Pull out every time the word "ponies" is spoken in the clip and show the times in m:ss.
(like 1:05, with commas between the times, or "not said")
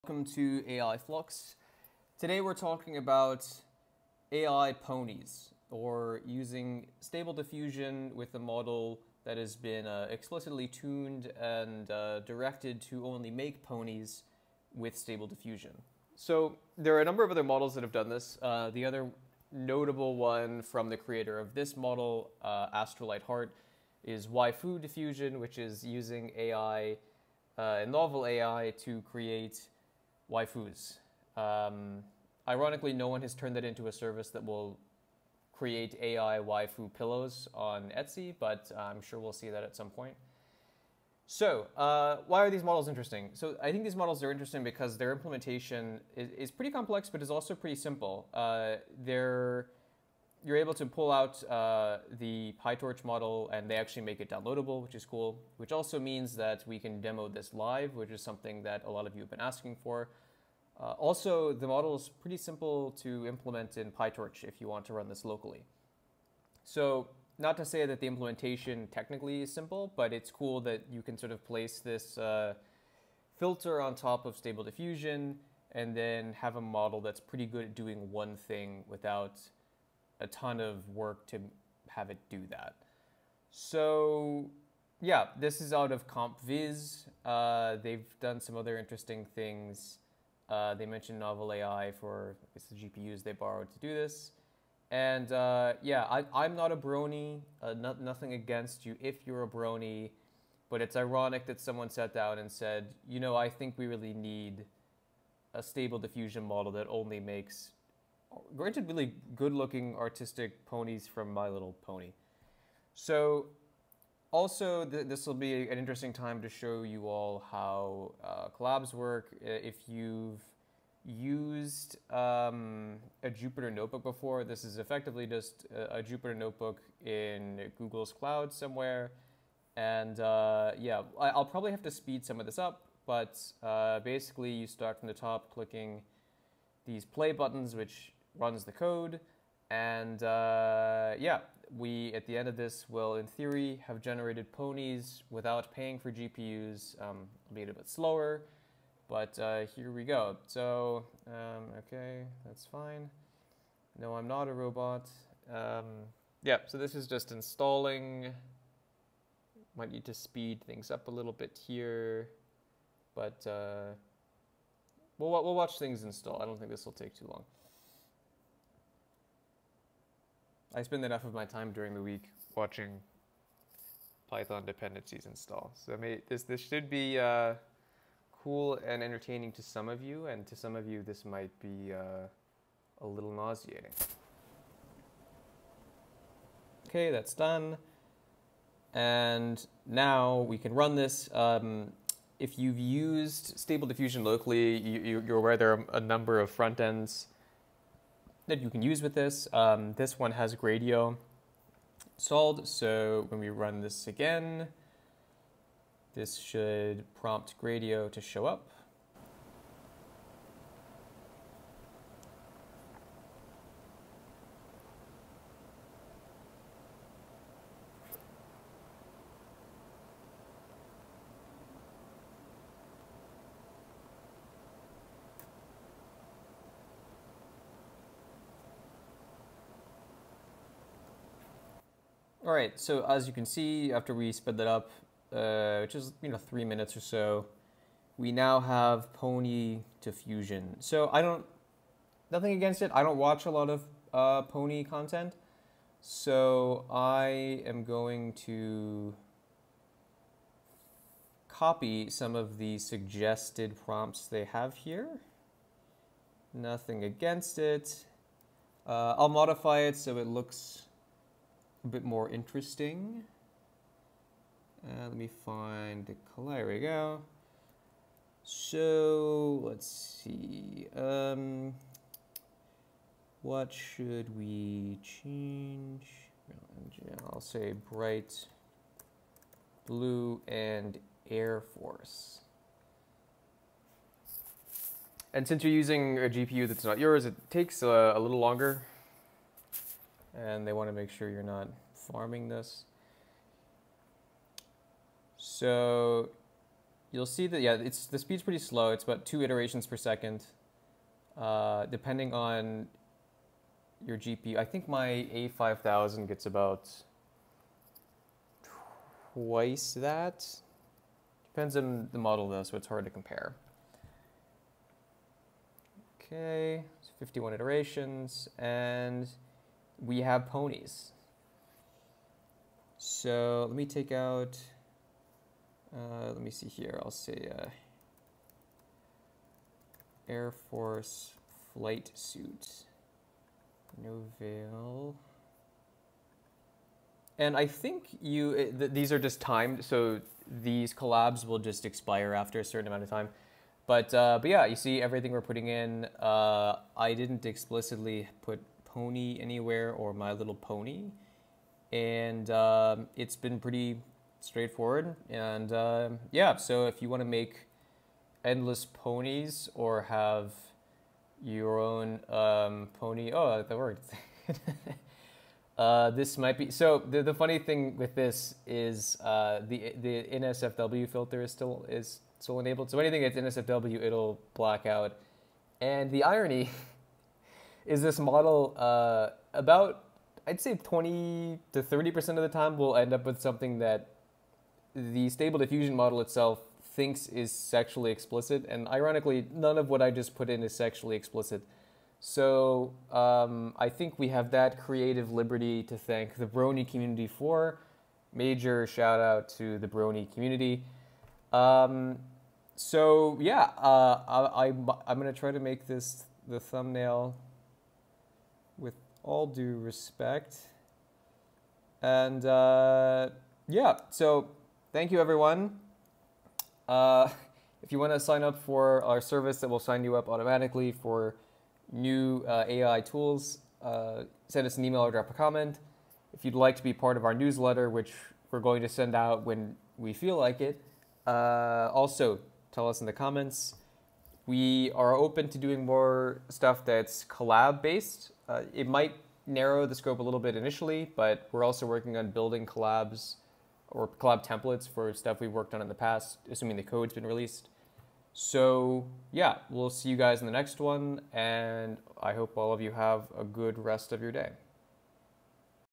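0:04, 0:13, 1:50, 2:24, 5:20, 5:58.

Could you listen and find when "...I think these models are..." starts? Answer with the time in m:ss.
0:43.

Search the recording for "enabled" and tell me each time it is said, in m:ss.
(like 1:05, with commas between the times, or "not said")
6:12.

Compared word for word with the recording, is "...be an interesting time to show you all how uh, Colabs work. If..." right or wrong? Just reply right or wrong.
right.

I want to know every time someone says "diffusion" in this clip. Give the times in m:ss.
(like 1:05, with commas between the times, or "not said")
0:07, 0:15, 0:24, 1:14, 1:45, 3:13, 4:00, 6:25.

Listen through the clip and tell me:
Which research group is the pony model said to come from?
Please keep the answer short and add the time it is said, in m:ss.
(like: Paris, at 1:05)
CompVis, at 1:26.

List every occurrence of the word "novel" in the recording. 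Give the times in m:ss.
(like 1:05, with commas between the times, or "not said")
0:27, 1:31.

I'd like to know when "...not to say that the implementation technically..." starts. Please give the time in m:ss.
1:07.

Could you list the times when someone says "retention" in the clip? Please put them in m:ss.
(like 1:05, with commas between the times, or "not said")
not said.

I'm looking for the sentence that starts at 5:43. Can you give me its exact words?
But, uh, but yeah, you see everything we're putting in.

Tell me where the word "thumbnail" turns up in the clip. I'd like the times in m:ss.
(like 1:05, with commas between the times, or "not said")
6:46.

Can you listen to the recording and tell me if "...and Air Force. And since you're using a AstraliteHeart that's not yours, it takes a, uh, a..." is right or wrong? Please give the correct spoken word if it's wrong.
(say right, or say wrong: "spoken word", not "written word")
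wrong: "GPU", not "AstraliteHeart".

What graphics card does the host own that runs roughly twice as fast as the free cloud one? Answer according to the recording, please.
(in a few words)
A5000.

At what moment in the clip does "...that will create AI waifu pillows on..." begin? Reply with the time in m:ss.
0:34.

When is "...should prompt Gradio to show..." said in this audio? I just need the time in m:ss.
3:26.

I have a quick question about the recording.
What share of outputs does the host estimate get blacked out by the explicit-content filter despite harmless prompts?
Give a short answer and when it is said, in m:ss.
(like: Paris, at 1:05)
20 to 30 percent, at 6:20.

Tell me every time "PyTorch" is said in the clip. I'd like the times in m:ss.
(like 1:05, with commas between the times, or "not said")
0:52, 1:03.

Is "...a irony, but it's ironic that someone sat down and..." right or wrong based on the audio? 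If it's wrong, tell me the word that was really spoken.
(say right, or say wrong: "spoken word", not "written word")
wrong: "brony", not "irony".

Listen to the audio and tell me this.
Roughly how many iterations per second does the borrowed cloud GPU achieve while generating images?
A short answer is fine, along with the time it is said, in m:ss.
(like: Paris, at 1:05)
2, at 4:59.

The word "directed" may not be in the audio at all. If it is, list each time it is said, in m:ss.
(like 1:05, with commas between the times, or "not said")
0:12.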